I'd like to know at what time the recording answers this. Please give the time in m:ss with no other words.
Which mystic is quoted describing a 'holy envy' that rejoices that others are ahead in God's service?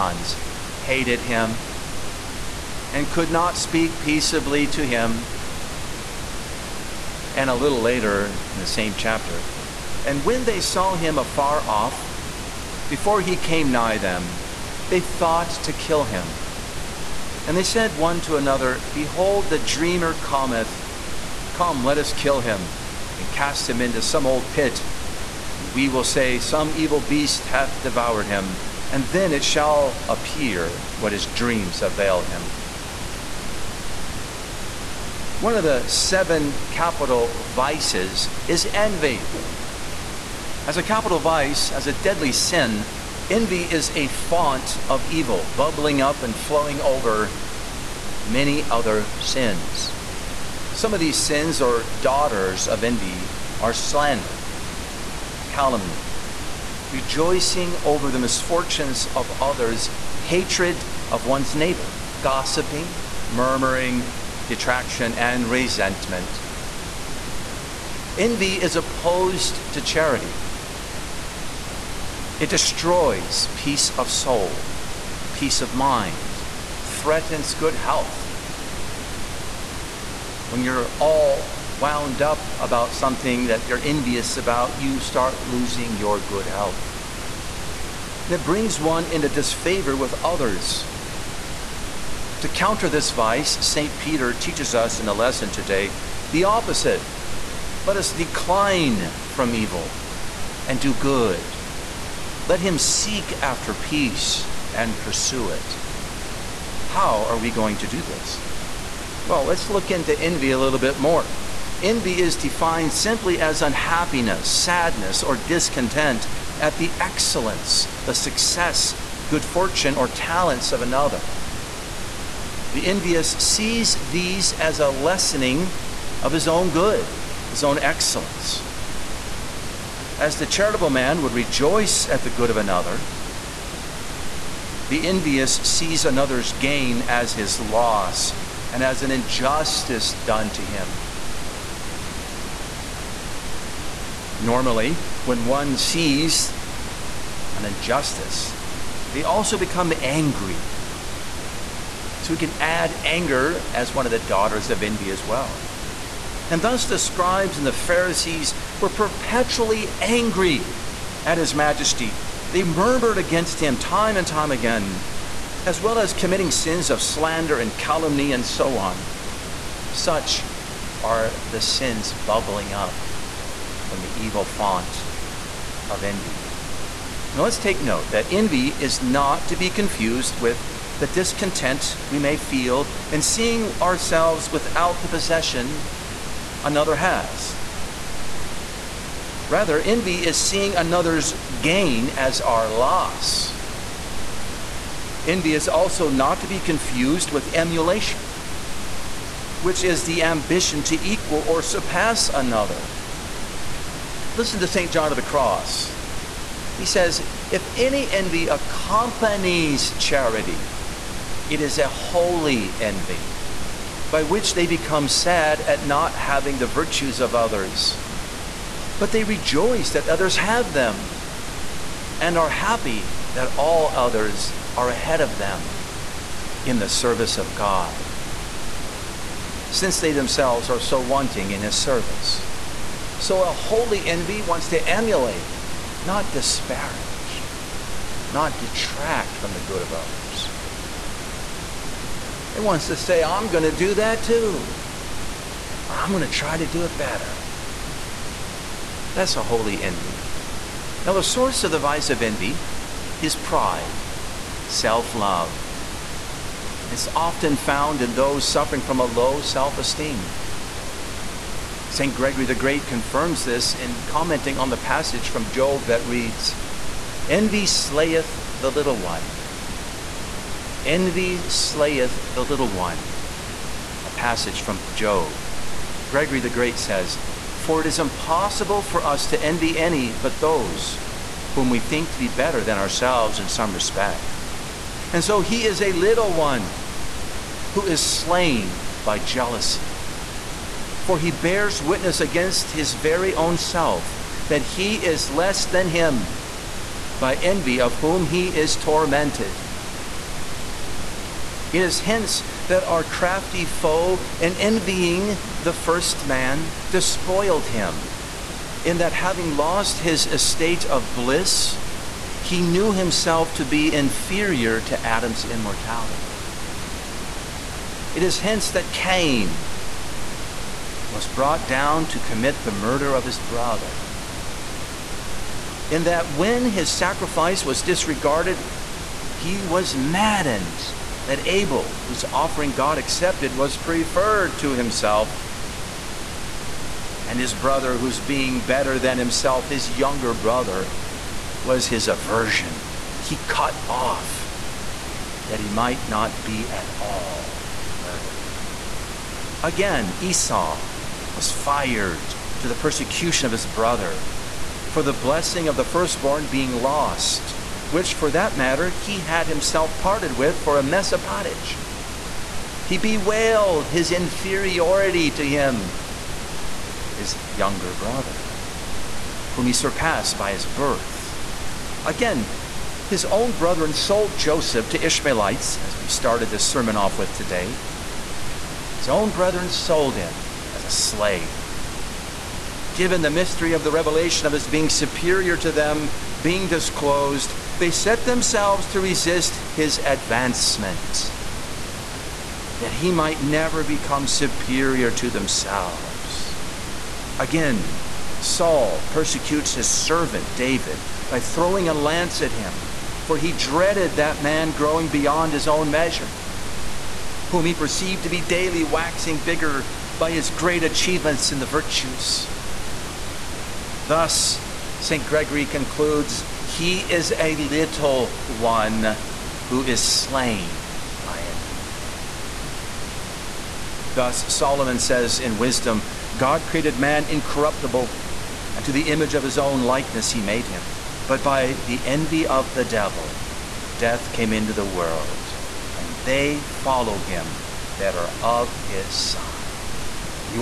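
3:24.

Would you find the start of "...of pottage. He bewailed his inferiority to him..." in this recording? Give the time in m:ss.
6:01.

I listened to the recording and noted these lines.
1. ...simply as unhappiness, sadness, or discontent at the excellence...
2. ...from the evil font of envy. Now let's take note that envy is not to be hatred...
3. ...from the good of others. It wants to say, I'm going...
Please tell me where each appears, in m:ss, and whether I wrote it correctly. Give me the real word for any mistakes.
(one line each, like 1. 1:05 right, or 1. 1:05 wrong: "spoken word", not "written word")
1. 1:52 right
2. 2:53 wrong: "confused", not "hatred"
3. 3:59 right.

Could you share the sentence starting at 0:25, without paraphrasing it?
And we will say, Some evil beast hath devoured him, and then it shall appear what his dreams avail him.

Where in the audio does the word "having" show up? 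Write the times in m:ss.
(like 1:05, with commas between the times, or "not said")
3:36, 5:09.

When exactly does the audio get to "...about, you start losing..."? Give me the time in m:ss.
1:24.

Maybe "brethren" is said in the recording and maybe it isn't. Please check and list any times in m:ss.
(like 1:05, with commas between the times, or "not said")
6:13, 6:19.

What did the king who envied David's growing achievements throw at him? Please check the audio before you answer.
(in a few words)
A lance.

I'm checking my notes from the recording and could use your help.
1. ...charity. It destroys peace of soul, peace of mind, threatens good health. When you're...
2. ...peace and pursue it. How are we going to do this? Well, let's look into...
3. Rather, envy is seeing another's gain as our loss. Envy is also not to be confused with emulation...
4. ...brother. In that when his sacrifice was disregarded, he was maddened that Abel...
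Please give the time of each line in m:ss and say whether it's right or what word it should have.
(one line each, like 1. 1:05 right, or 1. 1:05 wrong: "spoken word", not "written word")
1. 1:09 right
2. 1:43 right
3. 3:09 right
4. 5:23 right.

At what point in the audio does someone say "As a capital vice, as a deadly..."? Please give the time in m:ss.
0:40.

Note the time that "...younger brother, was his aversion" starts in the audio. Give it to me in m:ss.
5:39.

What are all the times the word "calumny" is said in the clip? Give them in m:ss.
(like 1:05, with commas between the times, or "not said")
0:55, 2:47.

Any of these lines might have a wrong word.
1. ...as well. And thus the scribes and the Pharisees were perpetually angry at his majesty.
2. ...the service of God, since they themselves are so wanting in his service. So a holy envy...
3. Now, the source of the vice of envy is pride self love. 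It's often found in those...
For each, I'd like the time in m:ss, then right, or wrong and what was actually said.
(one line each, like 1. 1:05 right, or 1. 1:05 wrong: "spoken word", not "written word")
1. 2:35 right
2. 3:46 right
3. 4:11 right.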